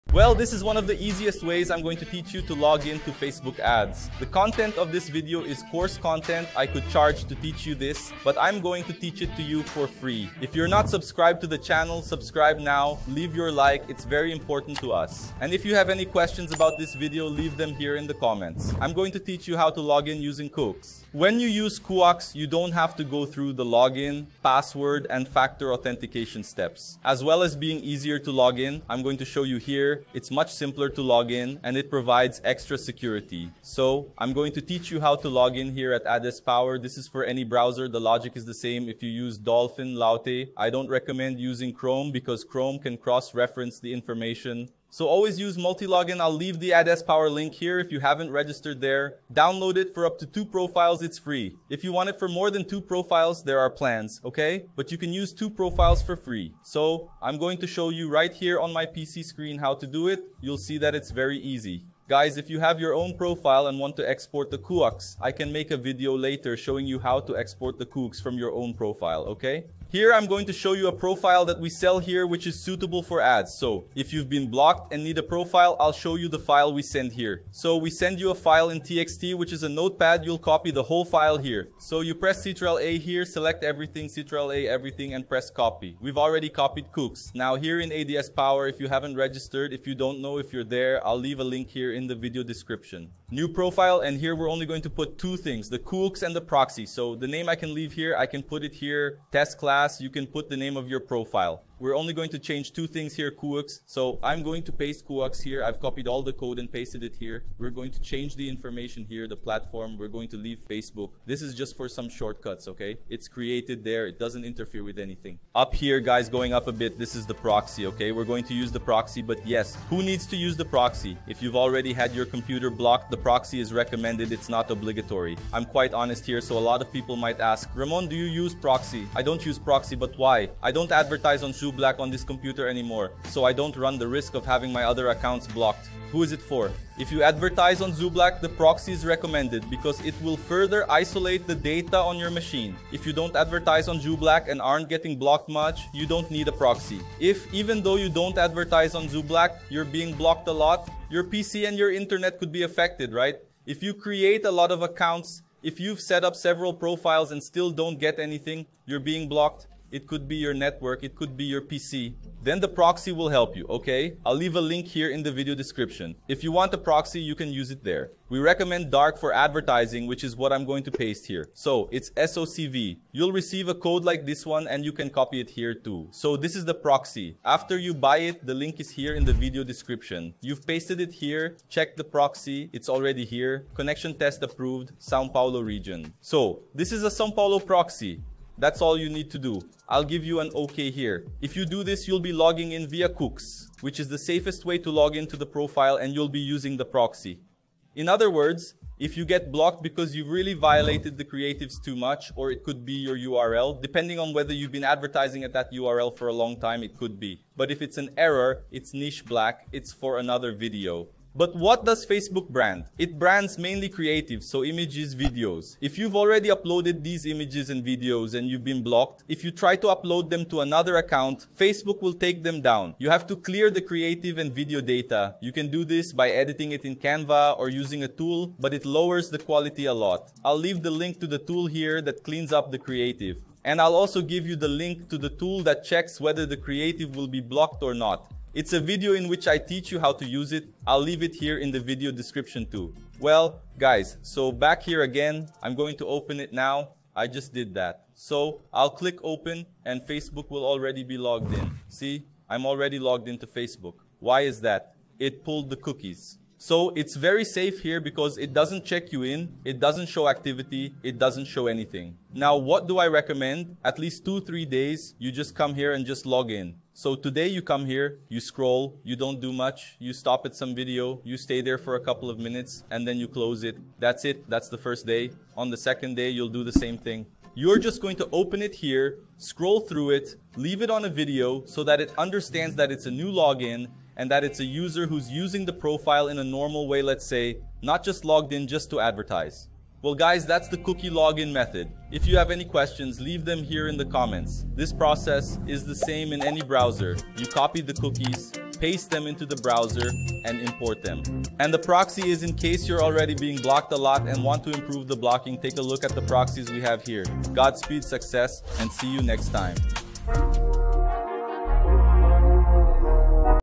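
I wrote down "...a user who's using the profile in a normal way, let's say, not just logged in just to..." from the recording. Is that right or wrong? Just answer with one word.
right.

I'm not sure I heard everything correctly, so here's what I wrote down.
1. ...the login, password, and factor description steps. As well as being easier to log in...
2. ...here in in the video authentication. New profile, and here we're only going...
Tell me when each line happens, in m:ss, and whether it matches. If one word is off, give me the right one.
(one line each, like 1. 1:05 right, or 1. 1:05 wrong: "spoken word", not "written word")
1. 0:23 wrong: "authentication", not "description"
2. 1:31 wrong: "description", not "authentication".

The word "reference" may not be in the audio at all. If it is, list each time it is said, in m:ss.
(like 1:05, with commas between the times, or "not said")
0:42.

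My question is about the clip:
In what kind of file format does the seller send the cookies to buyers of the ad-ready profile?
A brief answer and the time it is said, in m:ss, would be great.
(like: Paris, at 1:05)
TXT, at 1:18.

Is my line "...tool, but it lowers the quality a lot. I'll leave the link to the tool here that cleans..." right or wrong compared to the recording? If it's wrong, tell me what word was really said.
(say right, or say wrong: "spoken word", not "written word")
right.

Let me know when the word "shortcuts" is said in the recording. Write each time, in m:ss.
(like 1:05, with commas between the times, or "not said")
1:52.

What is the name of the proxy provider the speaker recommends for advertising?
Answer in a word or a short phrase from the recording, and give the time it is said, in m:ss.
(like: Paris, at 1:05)
Dark, at 2:48.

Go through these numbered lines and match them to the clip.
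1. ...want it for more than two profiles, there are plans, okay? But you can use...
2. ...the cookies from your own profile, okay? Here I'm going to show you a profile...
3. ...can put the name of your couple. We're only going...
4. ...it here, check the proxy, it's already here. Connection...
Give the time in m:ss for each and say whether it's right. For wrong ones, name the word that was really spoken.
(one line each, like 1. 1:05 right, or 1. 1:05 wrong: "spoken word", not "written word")
1. 0:51 right
2. 1:07 right
3. 1:40 wrong: "profile", not "couple"
4. 3:01 right.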